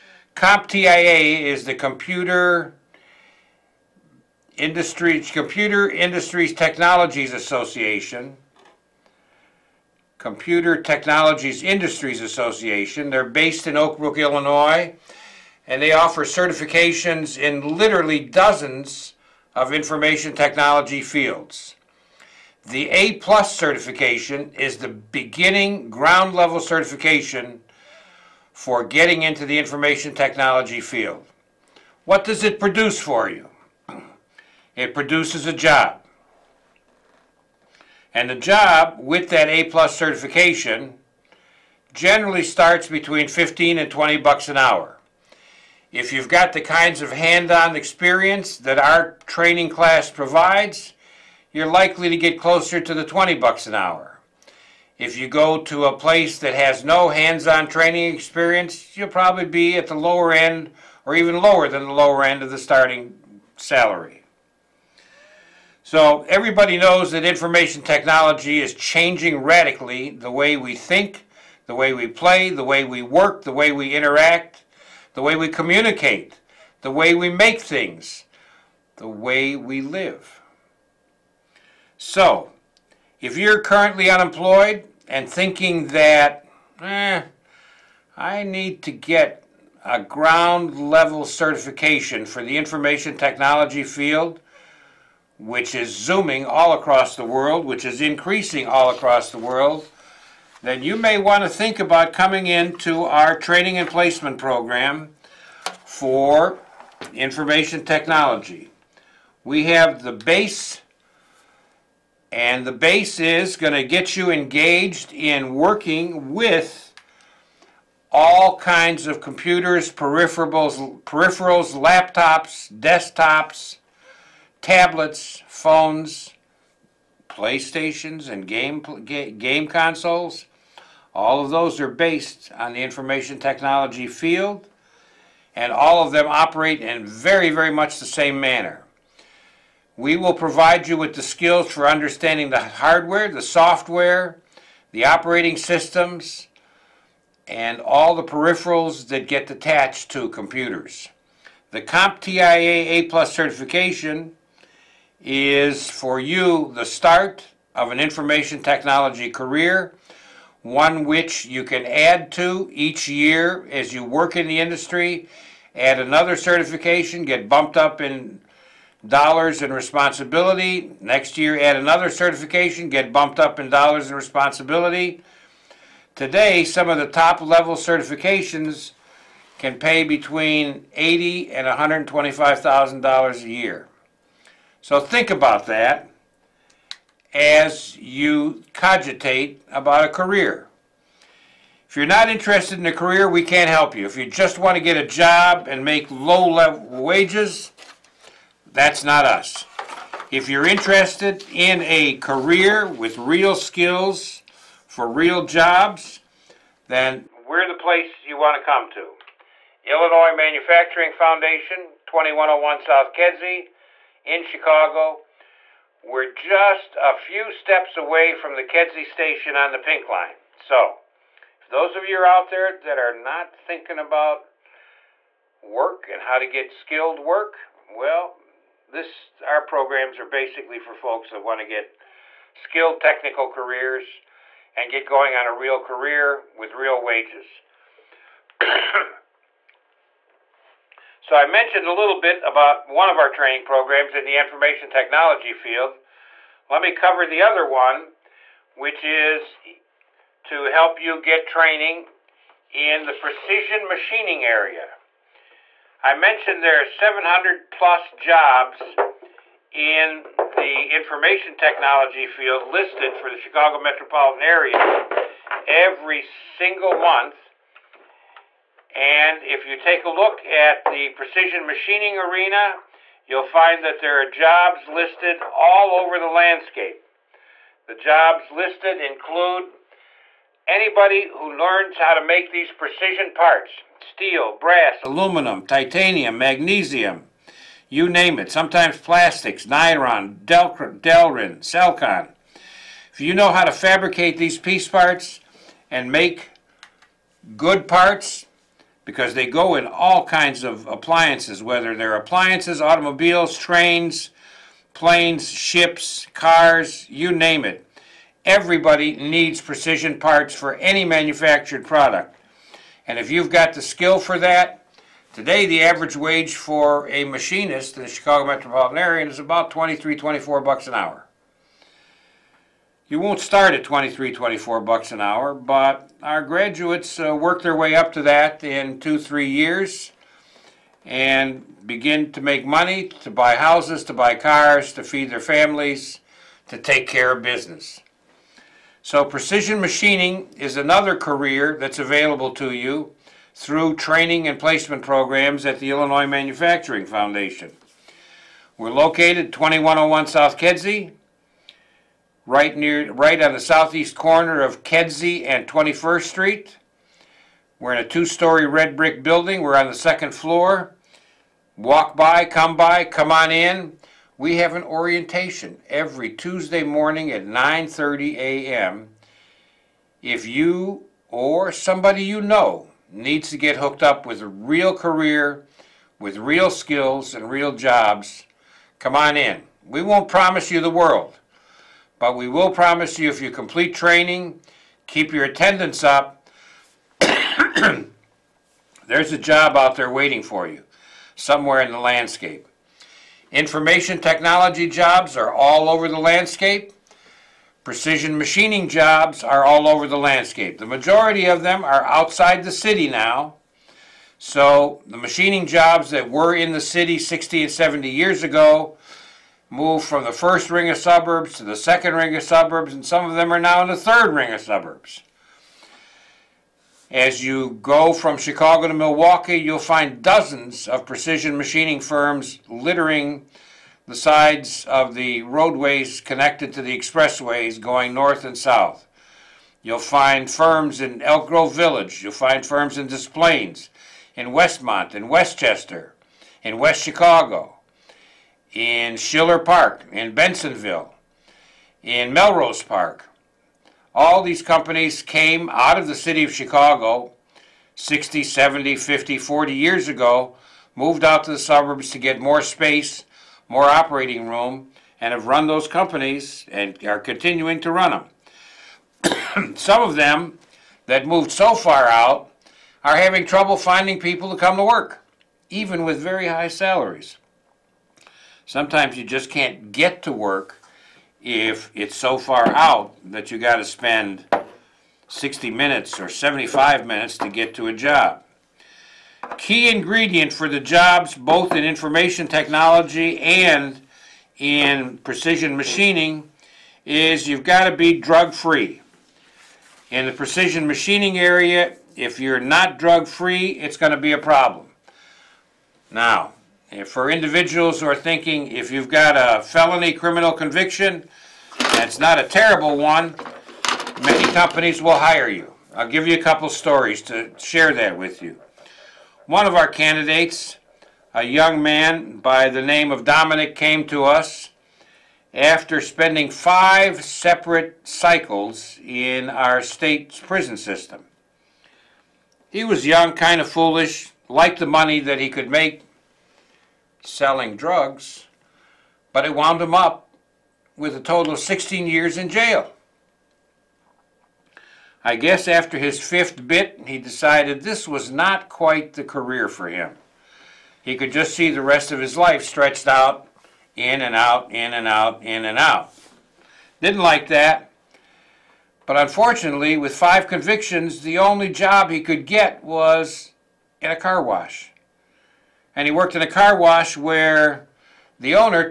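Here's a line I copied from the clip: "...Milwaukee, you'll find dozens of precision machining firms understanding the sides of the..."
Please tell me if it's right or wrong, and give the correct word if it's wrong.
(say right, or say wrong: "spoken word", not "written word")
wrong: "littering", not "understanding".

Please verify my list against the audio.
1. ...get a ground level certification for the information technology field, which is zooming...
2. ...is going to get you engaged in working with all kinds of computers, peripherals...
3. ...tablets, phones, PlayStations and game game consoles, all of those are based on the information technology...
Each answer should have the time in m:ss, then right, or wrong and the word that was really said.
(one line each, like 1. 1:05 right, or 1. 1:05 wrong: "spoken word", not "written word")
1. 1:28 right
2. 1:53 right
3. 2:04 right.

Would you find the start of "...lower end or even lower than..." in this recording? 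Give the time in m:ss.
0:59.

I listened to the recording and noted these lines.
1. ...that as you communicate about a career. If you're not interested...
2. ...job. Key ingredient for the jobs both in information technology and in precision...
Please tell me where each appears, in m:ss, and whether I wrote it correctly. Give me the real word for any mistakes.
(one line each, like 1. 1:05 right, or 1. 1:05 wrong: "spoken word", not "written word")
1. 3:05 wrong: "cogitate", not "communicate"
2. 7:57 right.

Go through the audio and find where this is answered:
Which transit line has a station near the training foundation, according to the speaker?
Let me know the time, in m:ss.
3:39.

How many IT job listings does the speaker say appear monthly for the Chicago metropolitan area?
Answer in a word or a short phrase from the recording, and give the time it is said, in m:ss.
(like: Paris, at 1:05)
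700+, at 4:16.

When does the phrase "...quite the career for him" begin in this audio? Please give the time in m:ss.
8:58.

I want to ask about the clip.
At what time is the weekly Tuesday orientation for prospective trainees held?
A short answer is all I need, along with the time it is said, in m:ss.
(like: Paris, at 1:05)
9:30 a.m., at 6:07.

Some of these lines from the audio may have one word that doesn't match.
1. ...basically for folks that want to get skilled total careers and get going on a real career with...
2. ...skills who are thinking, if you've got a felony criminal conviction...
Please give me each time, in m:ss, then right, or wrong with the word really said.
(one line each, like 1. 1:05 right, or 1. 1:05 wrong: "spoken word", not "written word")
1. 3:50 wrong: "technical", not "total"
2. 8:17 wrong: "individuals", not "skills".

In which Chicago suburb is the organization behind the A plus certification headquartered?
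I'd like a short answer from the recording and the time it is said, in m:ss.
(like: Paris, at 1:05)
Oak Brook, Illinois, at 0:13.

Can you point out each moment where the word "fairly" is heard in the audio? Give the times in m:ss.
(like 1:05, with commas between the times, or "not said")
not said.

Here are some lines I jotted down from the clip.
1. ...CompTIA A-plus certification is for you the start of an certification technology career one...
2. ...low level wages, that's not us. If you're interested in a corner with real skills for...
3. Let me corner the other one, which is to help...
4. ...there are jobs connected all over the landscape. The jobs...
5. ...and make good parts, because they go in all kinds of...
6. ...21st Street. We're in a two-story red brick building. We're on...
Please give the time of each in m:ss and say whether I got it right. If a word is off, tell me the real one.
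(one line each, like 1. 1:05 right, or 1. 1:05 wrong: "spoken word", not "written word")
1. 2:31 wrong: "information", not "certification"
2. 3:16 wrong: "career", not "corner"
3. 4:06 wrong: "cover", not "corner"
4. 4:33 wrong: "listed", not "connected"
5. 4:55 right
6. 5:55 right.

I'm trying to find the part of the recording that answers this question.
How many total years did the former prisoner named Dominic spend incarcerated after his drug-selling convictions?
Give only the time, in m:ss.
8:51.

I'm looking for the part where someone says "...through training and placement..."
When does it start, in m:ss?
5:43.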